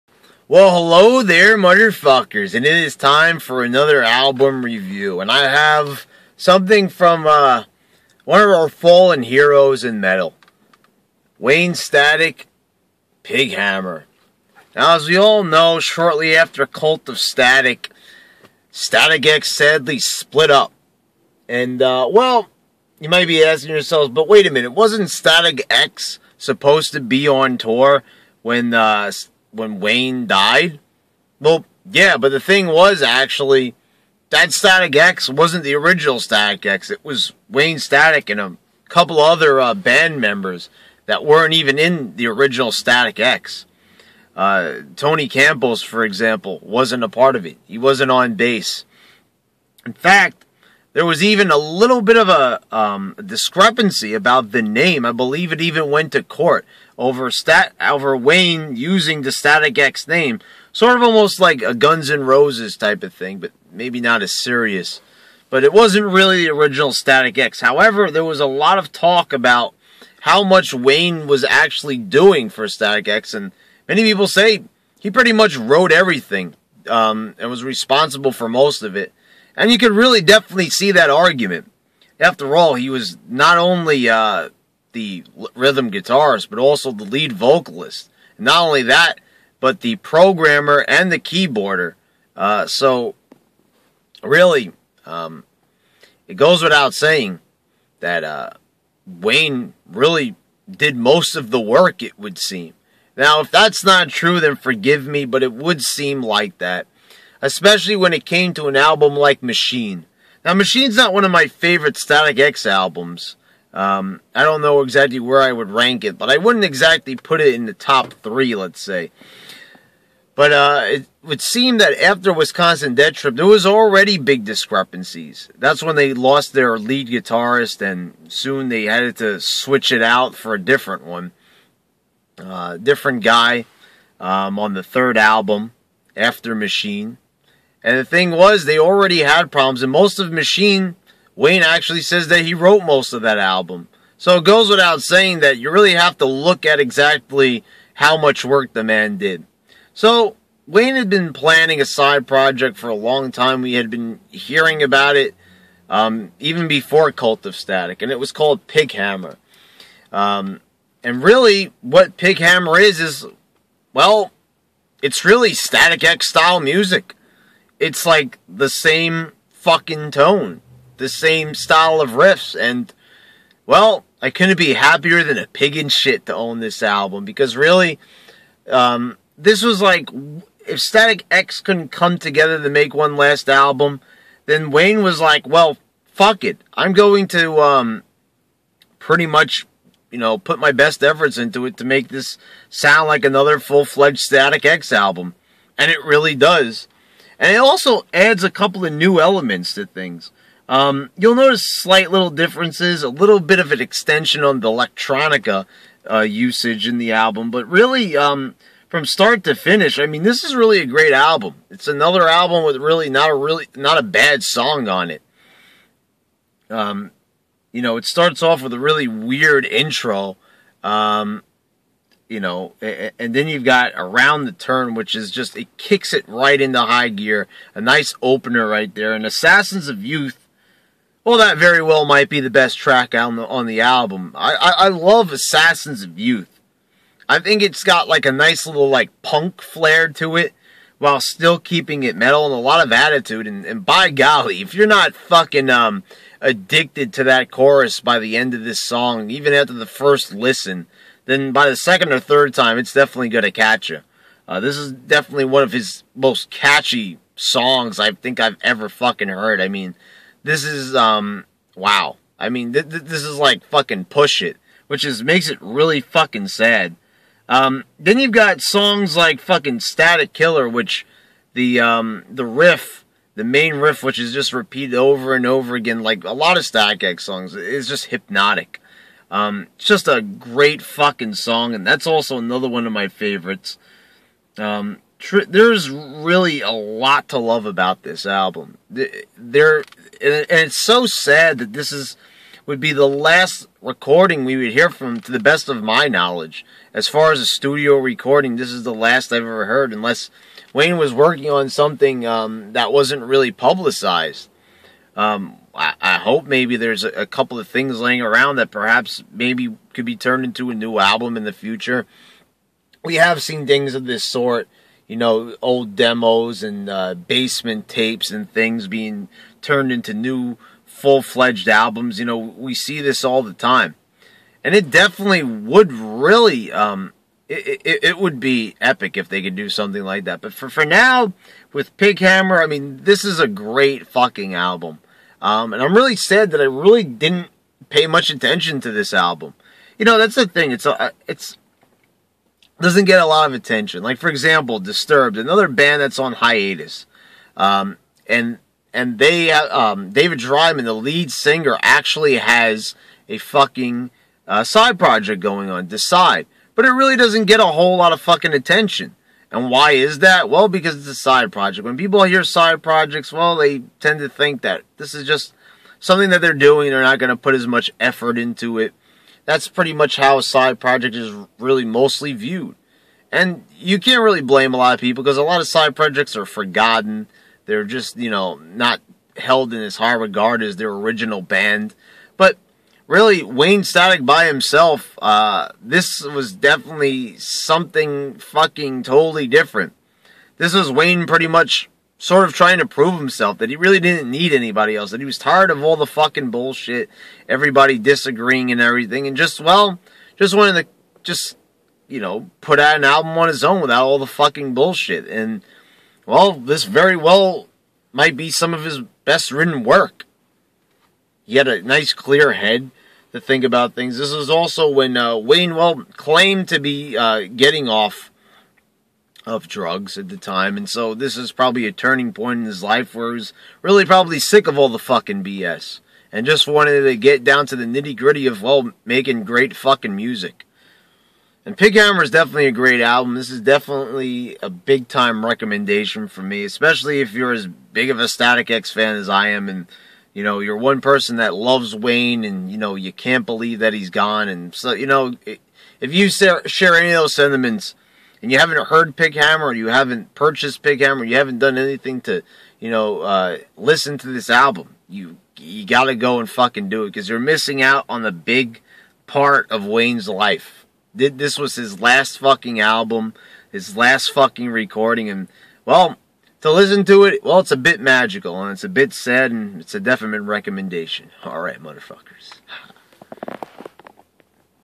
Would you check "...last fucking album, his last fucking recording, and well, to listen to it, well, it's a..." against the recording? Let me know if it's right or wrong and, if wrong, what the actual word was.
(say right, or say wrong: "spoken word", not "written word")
right.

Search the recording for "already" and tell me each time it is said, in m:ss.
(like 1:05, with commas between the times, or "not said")
2:03, 2:18.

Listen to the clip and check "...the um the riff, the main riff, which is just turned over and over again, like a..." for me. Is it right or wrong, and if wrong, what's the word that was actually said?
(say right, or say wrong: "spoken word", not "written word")
wrong: "repeated", not "turned".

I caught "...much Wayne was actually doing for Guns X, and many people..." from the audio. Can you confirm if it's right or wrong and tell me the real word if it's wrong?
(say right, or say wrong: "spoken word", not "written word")
wrong: "Static", not "Guns".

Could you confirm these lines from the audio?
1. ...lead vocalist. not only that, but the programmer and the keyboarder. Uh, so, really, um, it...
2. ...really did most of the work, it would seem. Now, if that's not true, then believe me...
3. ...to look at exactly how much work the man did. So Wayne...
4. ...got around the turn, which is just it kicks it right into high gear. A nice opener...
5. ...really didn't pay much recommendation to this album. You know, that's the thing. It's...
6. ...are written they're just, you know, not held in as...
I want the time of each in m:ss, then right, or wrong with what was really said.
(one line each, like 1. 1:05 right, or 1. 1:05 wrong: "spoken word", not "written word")
1. 1:27 right
2. 1:39 wrong: "forgive", not "believe"
3. 2:26 right
4. 3:43 right
5. 5:36 wrong: "attention", not "recommendation"
6. 6:16 wrong: "forgotten", not "written".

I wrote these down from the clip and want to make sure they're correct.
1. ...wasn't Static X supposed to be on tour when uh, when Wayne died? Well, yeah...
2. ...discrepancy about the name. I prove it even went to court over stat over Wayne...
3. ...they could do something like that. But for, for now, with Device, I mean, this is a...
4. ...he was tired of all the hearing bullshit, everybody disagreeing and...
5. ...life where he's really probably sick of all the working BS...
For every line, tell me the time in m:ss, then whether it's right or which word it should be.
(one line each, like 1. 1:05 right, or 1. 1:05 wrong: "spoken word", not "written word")
1. 0:24 right
2. 0:53 wrong: "believe", not "prove"
3. 5:29 wrong: "Pighammer", not "Device"
4. 6:35 wrong: "fucking", not "hearing"
5. 7:02 wrong: "fucking", not "working".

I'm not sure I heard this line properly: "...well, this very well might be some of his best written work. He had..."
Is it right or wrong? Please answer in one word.
right.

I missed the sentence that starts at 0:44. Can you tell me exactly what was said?
Uh, Tony Campbell's, for example, wasn't a part of it.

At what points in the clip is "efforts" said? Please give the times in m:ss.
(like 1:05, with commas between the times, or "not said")
3:11, 6:07.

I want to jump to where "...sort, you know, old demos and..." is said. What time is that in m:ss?
5:14.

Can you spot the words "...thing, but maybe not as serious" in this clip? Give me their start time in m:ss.
1:03.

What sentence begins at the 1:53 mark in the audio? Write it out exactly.
Um, I don't know exactly where I would rank it, but I wouldn't exactly put it in the top three, let's say.